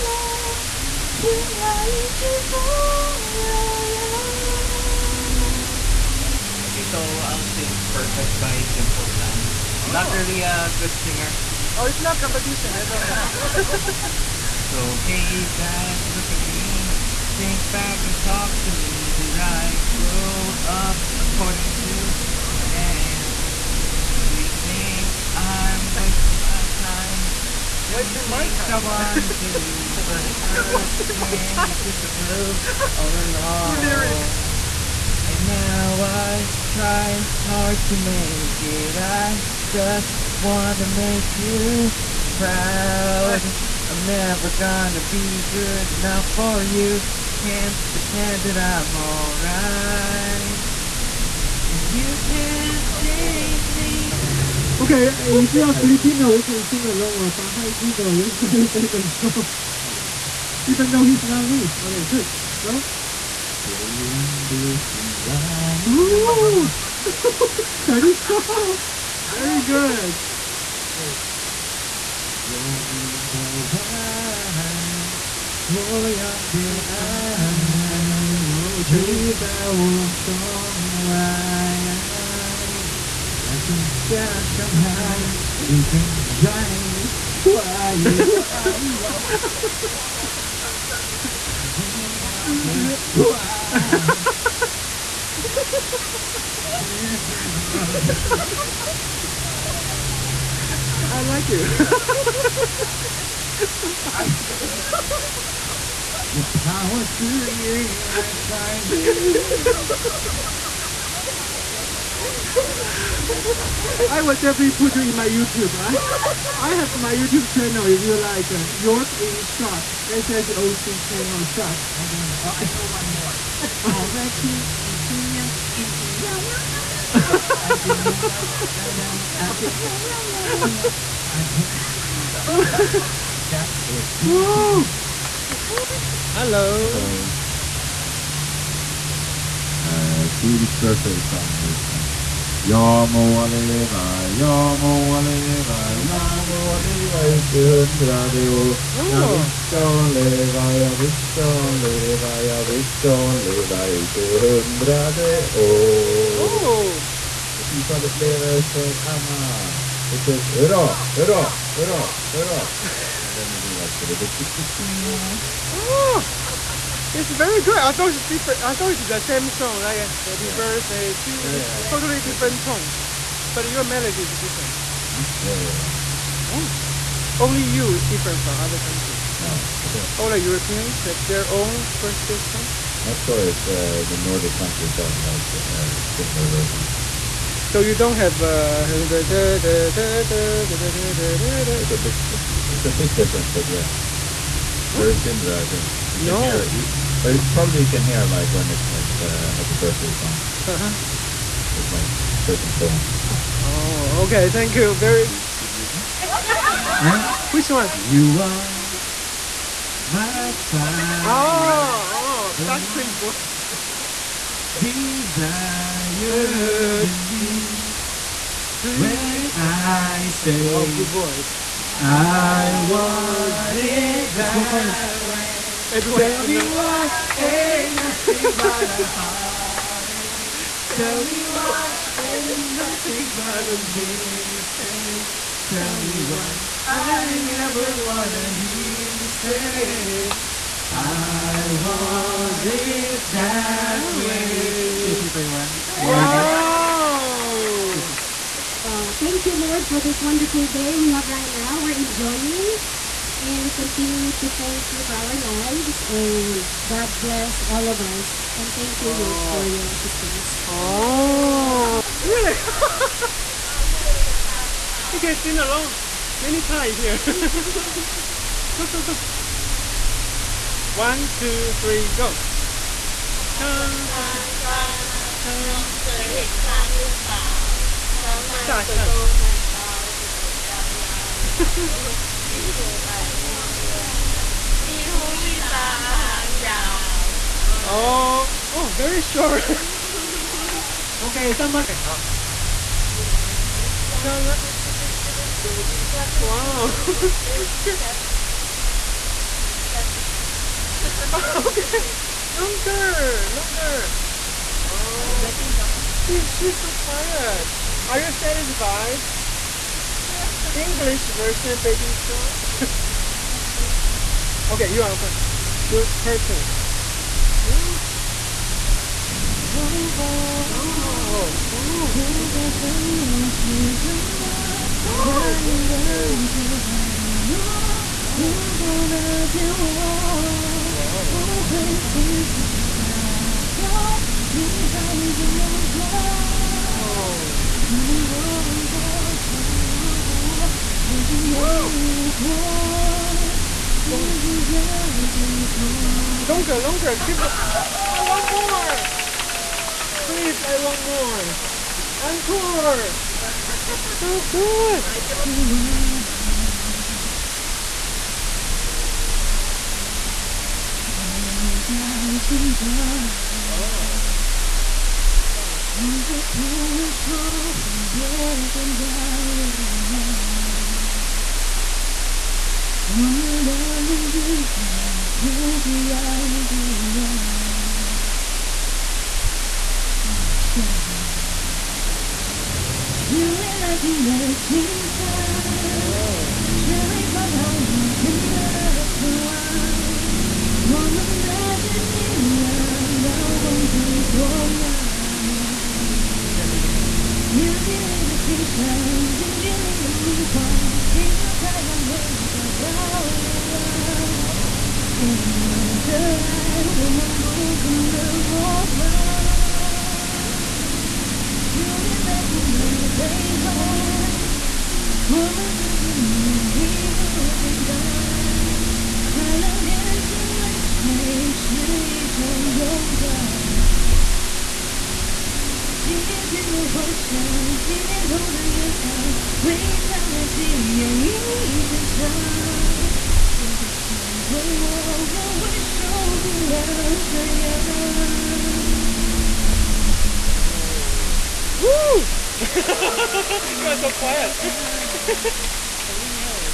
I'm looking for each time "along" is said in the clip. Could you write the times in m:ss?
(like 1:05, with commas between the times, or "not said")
0:33, 0:56, 4:25.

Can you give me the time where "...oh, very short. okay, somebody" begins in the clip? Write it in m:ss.
4:48.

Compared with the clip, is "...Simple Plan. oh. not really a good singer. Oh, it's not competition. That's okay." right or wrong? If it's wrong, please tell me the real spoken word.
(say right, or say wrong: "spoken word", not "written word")
right.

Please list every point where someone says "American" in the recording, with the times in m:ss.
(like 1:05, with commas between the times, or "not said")
not said.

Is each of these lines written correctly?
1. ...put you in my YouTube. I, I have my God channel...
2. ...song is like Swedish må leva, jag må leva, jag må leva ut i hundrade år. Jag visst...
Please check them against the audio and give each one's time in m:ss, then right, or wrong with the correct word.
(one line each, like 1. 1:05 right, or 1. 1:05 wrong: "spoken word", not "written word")
1. 1:54 wrong: "YouTube", not "God"
2. 2:21 wrong: "Jag", not "Swedish".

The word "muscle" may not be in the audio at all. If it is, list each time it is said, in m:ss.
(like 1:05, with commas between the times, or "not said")
not said.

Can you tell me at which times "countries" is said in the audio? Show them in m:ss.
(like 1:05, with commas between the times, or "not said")
2:58, 3:04.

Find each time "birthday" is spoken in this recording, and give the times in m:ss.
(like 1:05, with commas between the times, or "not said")
2:20, 2:50, 3:02, 3:19.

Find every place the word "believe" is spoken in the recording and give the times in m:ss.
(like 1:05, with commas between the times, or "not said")
3:37.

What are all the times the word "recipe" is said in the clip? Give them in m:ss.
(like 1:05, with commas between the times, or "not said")
not said.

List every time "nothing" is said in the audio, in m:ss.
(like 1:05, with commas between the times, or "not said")
3:48, 3:52.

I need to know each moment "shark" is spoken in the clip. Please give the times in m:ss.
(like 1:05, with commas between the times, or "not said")
4:56, 5:12.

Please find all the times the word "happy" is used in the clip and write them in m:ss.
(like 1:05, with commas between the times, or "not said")
2:50, 3:19.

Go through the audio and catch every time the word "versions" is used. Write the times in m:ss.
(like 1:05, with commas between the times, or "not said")
3:06, 5:11.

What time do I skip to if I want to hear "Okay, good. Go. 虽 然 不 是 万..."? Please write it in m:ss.
1:01.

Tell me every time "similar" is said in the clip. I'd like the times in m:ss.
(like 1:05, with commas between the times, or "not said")
3:06, 3:15.